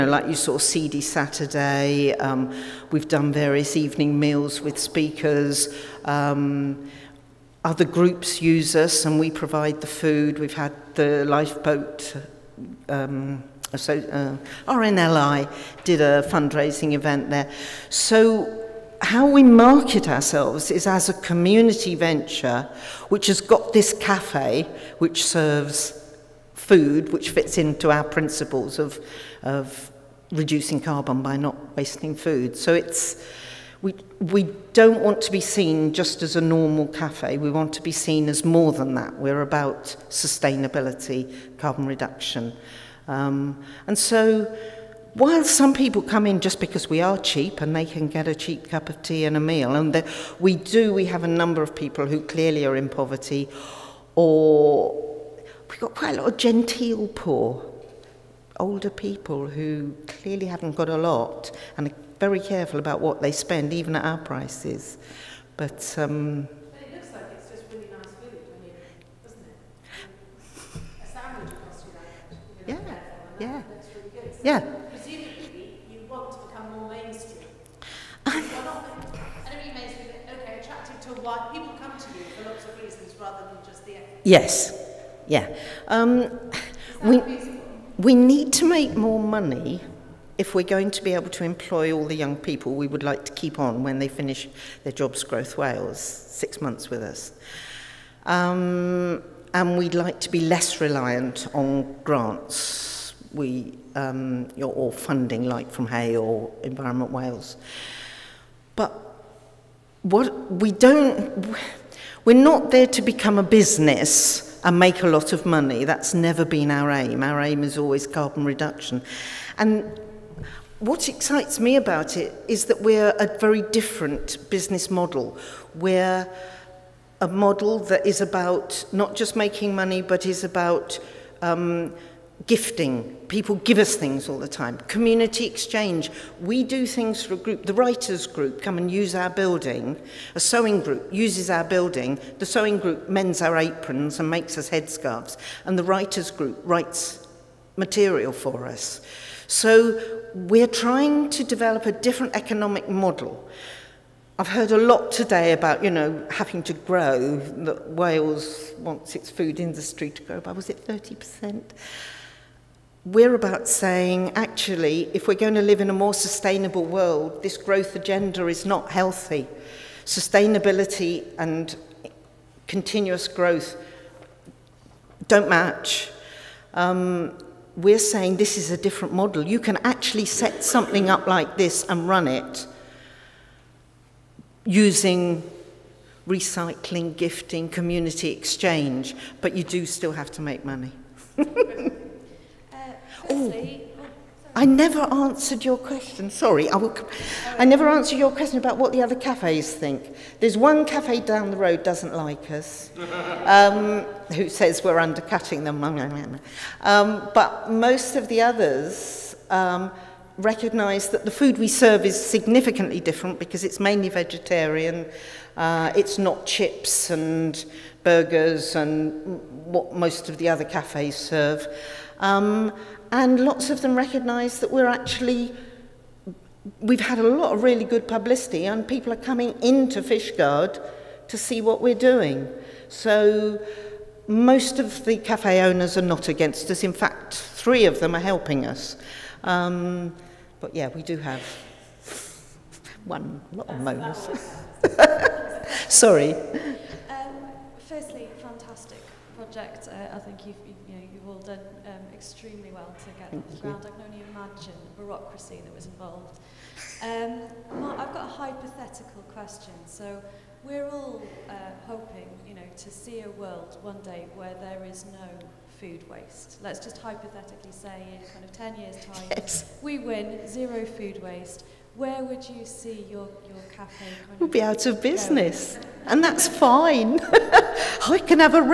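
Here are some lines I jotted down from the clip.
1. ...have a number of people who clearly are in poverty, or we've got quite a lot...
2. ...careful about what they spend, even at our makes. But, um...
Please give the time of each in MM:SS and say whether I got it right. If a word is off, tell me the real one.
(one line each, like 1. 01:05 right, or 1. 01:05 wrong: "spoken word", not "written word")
1. 00:51 right
2. 01:02 wrong: "prices", not "makes".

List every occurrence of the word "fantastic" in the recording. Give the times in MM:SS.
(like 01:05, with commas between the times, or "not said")
04:08.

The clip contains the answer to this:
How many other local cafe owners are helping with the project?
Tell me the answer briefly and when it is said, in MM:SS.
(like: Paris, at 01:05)
3, at 03:57.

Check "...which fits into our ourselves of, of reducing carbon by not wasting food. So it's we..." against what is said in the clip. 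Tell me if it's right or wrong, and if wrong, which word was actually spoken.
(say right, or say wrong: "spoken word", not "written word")
wrong: "principles", not "ourselves".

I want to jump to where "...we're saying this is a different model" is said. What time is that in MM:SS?
02:57.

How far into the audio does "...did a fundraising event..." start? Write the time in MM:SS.
00:15.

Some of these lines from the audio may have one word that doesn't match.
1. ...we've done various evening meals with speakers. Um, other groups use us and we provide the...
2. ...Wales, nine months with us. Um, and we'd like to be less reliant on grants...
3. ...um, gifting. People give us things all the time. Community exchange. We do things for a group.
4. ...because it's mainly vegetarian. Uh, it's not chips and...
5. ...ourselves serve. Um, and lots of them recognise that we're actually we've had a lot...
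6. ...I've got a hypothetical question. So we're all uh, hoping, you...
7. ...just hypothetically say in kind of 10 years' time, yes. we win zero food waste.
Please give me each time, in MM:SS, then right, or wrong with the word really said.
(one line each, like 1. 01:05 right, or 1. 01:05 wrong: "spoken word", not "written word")
1. 00:02 right
2. 01:35 wrong: "six", not "nine"
3. 02:11 right
4. 03:33 right
5. 03:40 wrong: "cafes", not "ourselves"
6. 04:17 right
7. 04:26 right.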